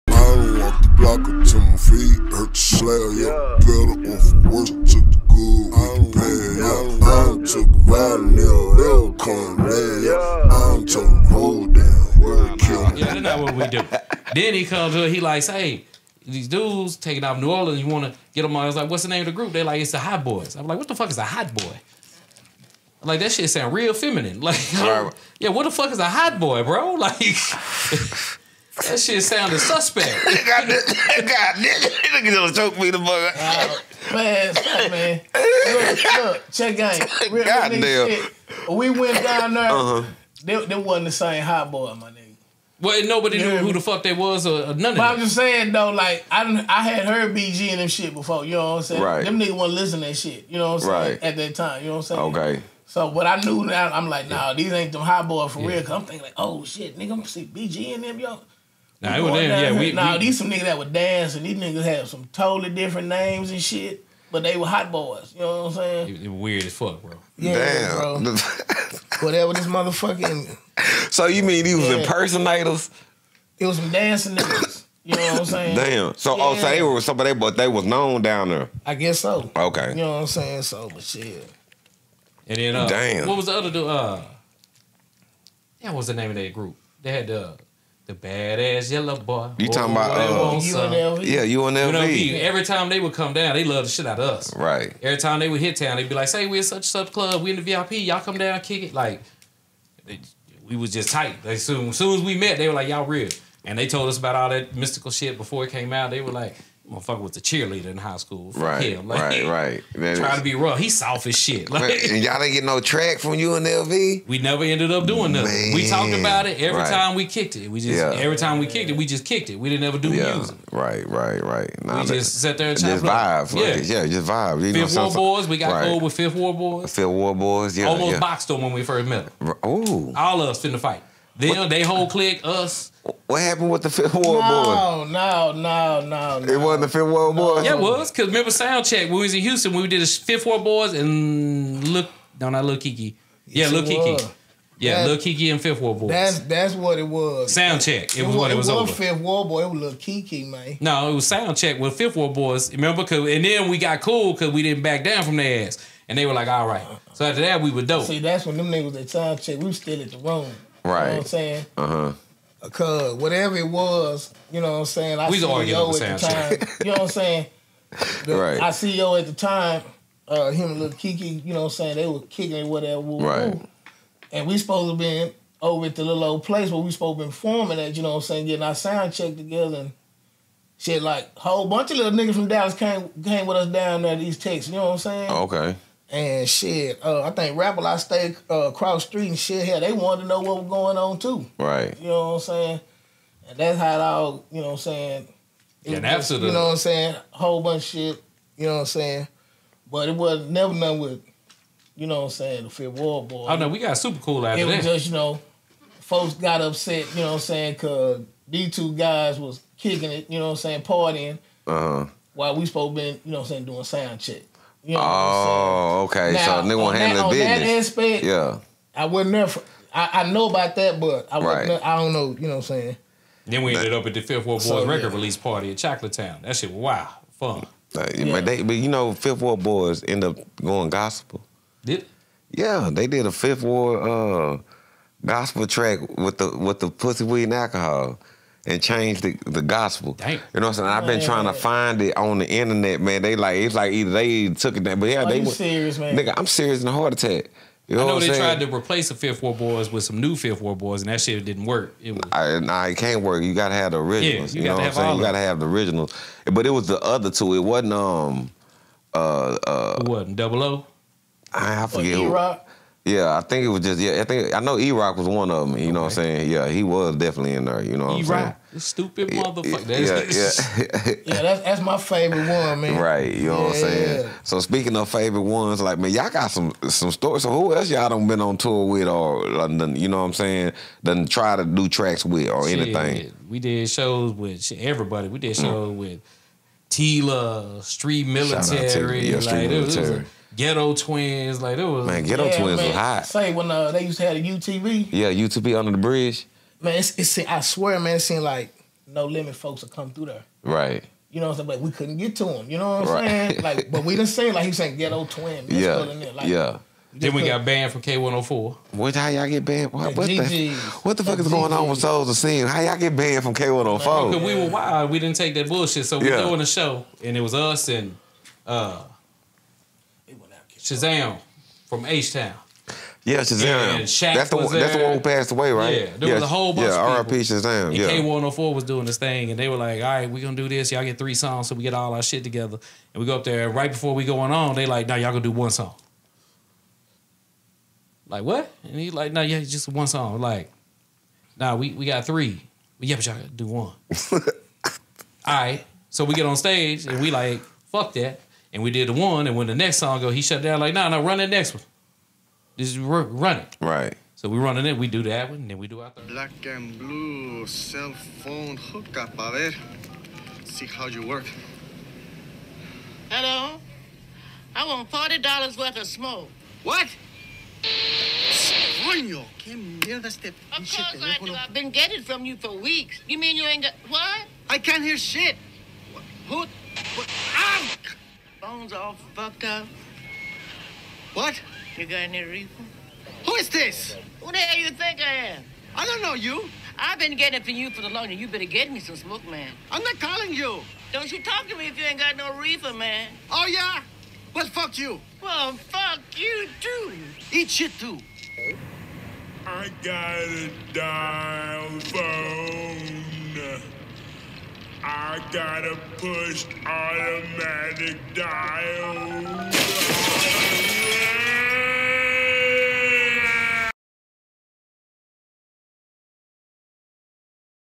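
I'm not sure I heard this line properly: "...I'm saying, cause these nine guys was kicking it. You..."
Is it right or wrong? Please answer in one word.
wrong.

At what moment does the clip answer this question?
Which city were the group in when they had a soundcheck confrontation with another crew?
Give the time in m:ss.
2:19.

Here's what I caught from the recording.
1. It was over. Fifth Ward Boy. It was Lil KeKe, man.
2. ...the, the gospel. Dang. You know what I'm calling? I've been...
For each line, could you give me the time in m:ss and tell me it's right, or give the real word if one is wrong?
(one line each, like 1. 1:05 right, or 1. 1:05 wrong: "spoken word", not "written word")
1. 2:28 right
2. 3:59 wrong: "saying", not "calling".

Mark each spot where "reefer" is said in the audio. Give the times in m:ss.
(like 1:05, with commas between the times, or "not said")
6:22, 6:32.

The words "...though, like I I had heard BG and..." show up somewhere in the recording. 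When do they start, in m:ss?
0:45.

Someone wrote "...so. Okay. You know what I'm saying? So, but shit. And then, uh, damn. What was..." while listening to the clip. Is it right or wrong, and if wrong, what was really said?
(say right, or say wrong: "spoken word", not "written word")
right.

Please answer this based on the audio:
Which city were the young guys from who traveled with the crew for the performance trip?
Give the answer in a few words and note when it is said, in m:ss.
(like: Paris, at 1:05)
Dallas, at 3:02.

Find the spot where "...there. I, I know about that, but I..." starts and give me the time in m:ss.
3:39.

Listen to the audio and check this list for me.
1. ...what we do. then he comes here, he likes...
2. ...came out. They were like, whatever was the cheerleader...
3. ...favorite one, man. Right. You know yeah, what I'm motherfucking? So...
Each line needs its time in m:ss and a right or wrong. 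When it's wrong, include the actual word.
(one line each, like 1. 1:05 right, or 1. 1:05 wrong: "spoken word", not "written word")
1. 0:13 right
2. 1:45 wrong: "motherfucker", not "whatever"
3. 4:31 wrong: "saying", not "motherfucking".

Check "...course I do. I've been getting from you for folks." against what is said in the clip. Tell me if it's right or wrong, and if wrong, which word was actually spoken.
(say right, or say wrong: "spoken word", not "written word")
wrong: "weeks", not "folks".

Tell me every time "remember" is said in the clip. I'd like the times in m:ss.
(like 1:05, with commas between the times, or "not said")
2:18, 2:32.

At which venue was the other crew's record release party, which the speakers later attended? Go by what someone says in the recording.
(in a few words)
Chocolate Town.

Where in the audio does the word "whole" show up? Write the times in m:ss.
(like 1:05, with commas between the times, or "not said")
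2:11, 3:01, 3:17, 5:26.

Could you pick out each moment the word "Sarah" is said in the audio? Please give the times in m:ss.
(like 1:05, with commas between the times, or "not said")
not said.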